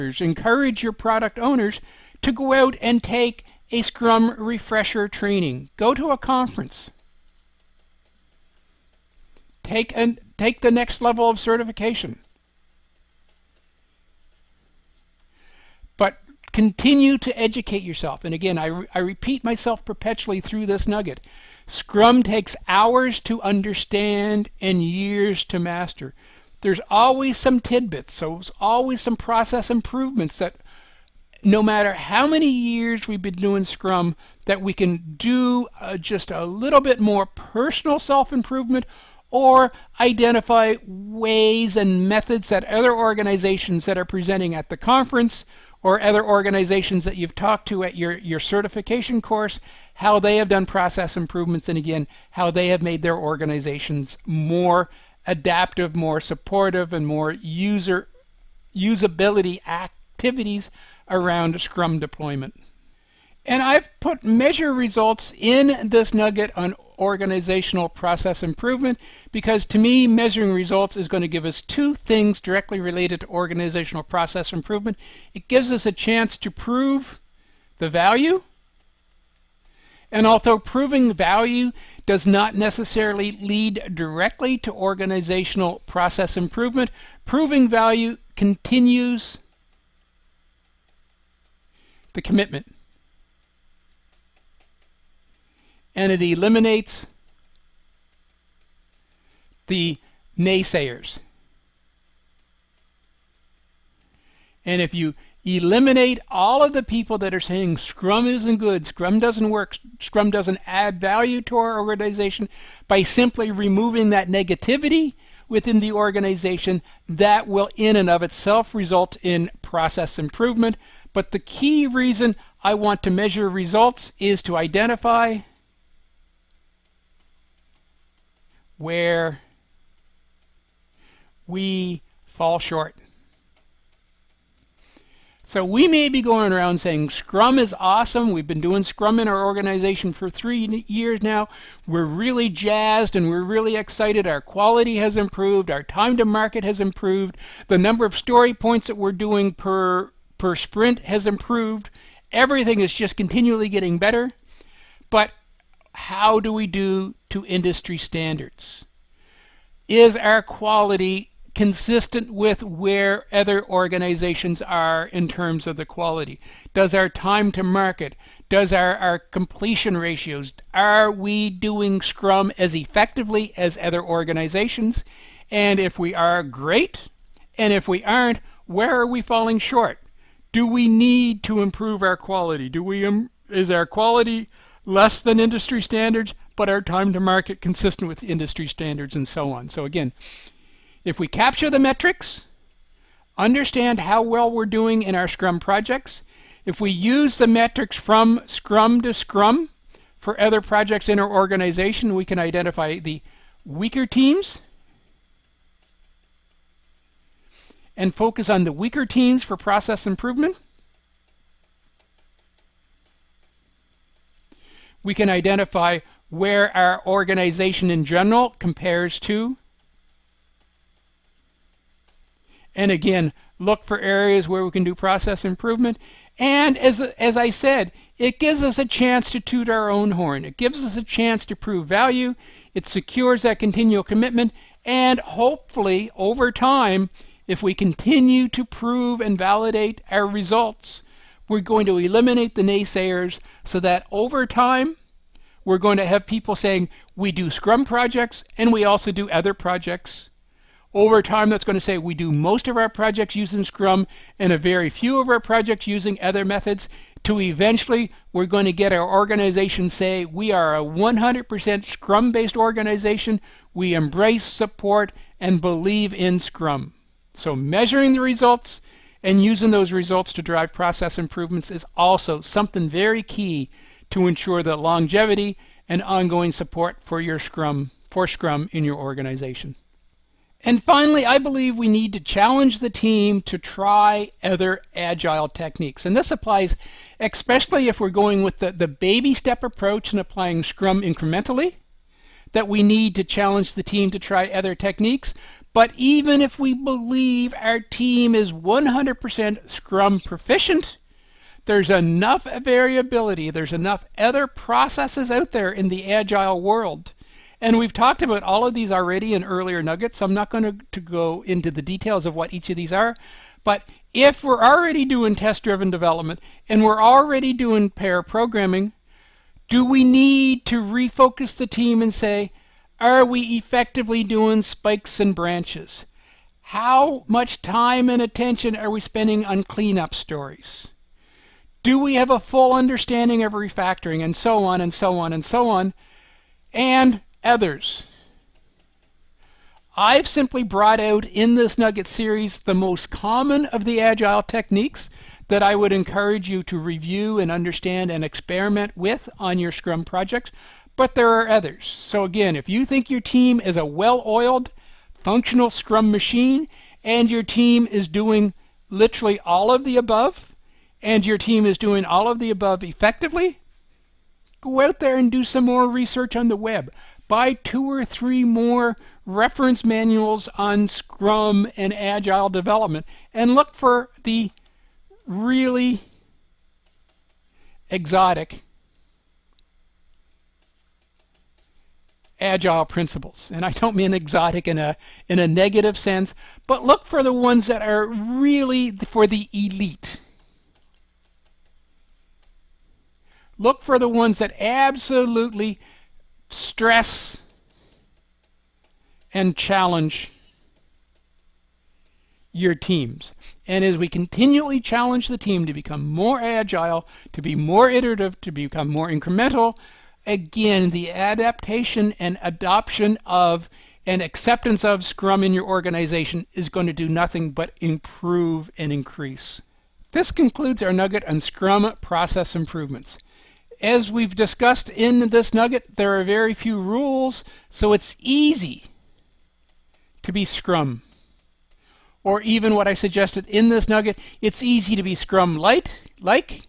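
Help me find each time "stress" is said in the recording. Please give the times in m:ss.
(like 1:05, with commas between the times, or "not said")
6:36.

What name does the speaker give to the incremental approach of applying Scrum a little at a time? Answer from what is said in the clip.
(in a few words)
Baby step approach.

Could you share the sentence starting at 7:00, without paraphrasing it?
This concludes our nugget on Scrum process improvements.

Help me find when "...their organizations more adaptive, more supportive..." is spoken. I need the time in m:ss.
0:53.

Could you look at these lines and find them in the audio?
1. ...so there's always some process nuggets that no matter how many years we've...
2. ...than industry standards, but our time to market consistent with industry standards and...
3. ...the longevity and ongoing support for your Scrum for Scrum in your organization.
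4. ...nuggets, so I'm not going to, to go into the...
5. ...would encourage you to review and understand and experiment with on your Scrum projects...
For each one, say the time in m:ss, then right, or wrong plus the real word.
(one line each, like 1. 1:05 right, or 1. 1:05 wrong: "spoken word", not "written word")
1. 0:28 wrong: "improvements", not "nuggets"
2. 3:05 right
3. 4:34 right
4. 5:09 right
5. 5:45 right.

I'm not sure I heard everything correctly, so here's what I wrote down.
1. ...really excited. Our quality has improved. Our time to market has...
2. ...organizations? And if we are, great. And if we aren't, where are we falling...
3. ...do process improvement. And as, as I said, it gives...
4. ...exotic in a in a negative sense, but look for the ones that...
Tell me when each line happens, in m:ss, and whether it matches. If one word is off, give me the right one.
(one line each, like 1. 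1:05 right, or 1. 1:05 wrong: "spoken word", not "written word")
1. 2:23 right
2. 2:54 right
3. 3:44 right
4. 6:24 right.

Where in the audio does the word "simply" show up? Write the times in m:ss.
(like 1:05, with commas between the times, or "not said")
1:53, 5:40.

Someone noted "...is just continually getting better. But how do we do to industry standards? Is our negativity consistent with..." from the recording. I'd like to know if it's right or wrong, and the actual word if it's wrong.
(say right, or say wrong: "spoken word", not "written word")
wrong: "quality", not "negativity".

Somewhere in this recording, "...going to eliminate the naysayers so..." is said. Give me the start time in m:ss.
4:01.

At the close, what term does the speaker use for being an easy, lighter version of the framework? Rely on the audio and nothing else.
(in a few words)
Scrum light.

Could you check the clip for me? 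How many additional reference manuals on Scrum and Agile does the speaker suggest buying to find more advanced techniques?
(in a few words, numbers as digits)
2 or 3.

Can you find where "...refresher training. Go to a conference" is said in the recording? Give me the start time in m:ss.
0:04.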